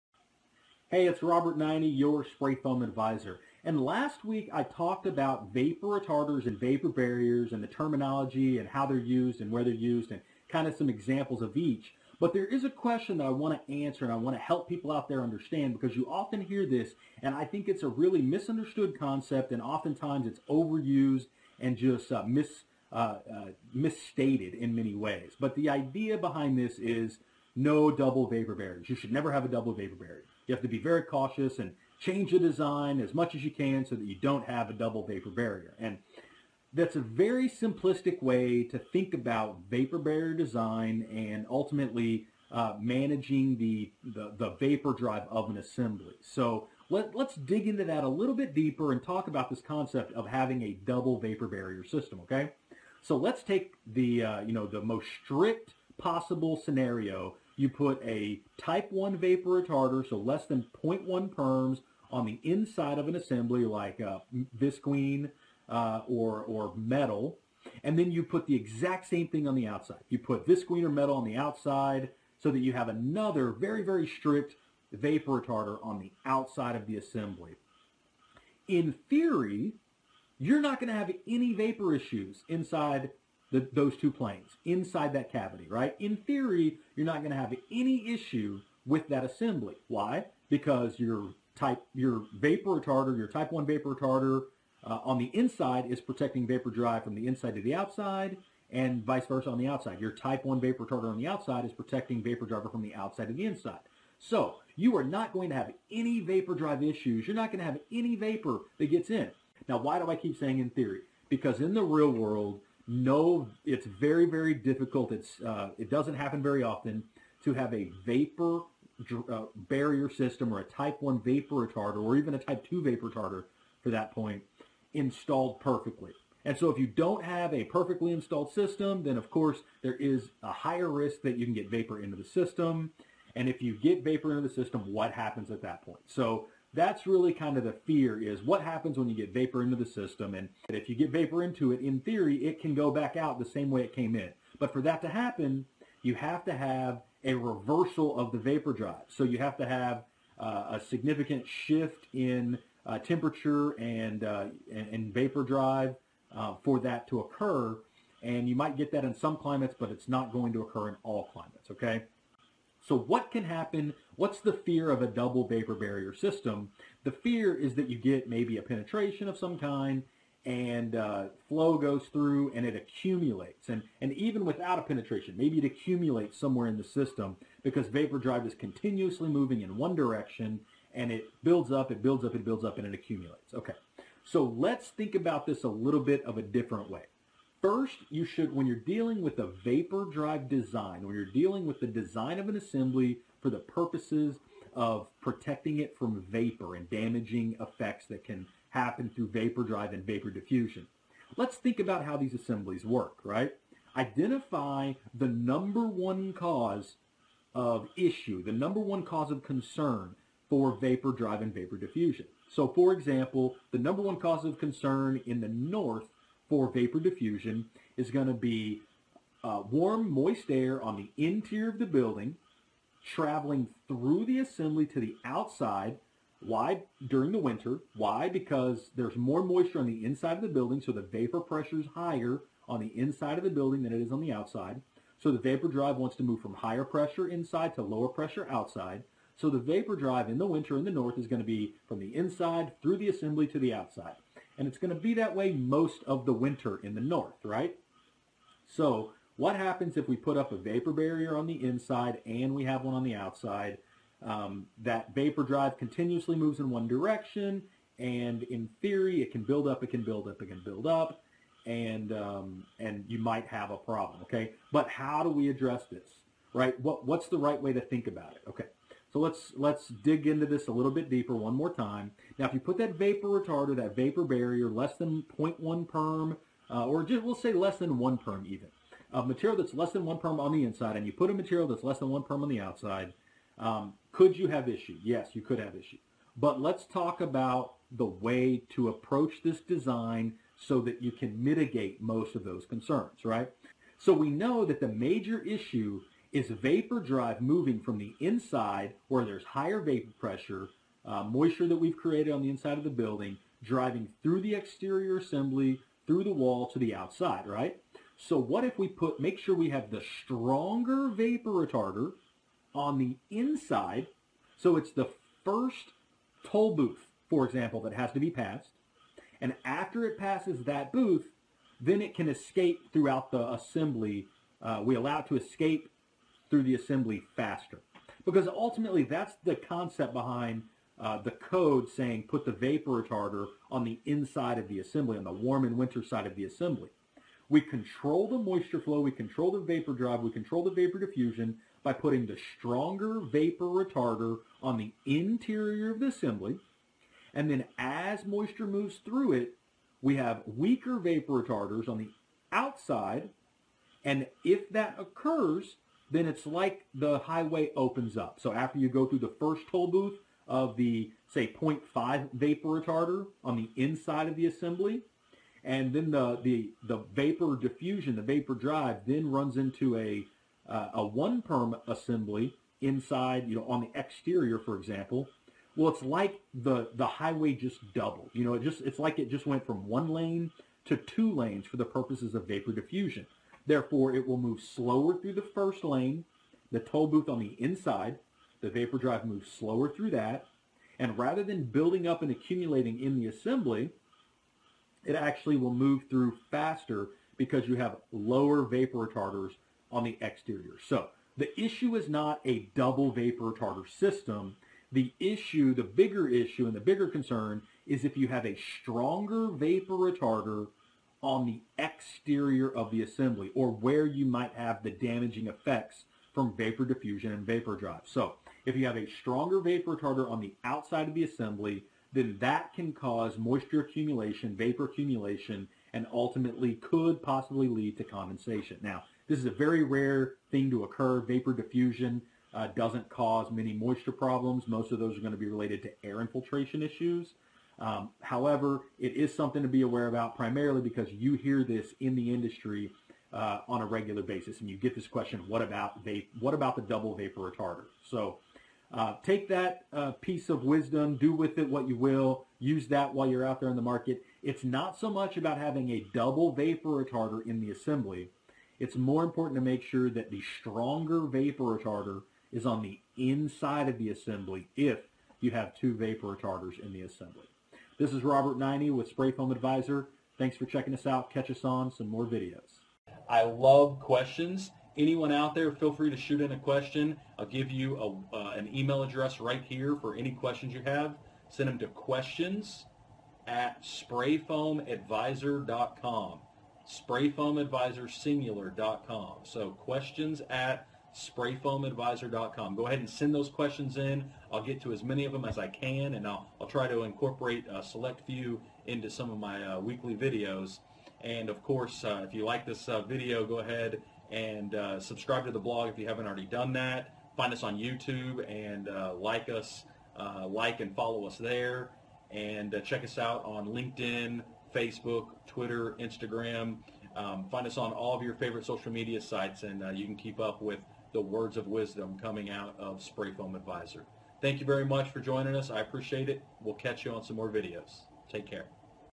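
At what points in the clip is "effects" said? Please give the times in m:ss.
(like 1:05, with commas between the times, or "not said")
3:17, 6:55.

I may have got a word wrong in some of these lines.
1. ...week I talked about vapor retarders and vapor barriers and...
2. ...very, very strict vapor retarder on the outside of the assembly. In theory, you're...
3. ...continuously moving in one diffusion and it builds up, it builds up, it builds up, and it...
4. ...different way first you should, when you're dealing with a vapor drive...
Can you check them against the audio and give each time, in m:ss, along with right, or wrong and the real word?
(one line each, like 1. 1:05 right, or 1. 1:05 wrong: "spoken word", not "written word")
1. 0:04 right
2. 1:13 right
3. 2:58 wrong: "direction", not "diffusion"
4. 3:06 right.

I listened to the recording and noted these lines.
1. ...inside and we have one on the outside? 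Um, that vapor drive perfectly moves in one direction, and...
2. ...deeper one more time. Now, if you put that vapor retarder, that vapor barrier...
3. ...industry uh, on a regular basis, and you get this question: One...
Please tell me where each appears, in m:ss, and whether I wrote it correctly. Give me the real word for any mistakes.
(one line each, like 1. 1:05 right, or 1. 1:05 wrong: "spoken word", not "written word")
1. 4:11 wrong: "continuously", not "perfectly"
2. 4:31 right
3. 7:22 wrong: "What", not "One".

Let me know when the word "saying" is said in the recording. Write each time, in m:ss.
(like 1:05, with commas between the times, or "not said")
1:50, 5:31.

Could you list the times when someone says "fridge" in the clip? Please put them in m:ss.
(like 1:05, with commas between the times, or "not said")
not said.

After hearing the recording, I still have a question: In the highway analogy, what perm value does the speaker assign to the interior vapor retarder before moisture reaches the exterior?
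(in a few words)
0.5.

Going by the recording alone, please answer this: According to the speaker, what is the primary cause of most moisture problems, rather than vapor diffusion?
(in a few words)
air infiltration.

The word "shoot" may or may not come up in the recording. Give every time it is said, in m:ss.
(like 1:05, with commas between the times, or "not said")
7:56.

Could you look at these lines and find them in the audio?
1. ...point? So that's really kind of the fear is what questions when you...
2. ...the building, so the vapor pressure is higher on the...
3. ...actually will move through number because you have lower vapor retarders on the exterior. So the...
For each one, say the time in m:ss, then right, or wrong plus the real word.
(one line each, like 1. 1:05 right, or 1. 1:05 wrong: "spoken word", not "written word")
1. 2:15 wrong: "happens", not "questions"
2. 3:50 right
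3. 6:35 wrong: "faster", not "number".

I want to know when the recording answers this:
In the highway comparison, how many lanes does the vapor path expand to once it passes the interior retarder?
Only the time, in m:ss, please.
6:20.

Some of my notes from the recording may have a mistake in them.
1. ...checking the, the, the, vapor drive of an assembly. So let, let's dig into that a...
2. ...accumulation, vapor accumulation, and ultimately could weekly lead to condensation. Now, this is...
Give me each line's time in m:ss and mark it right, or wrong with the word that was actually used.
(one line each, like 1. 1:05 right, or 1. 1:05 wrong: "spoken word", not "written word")
1. 0:42 wrong: "managing", not "checking"
2. 7:03 wrong: "possibly", not "weekly".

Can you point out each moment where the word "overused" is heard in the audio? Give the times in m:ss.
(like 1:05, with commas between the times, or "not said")
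0:20.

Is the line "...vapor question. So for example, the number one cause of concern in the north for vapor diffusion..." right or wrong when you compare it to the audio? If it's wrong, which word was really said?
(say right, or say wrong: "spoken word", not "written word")
wrong: "diffusion", not "question".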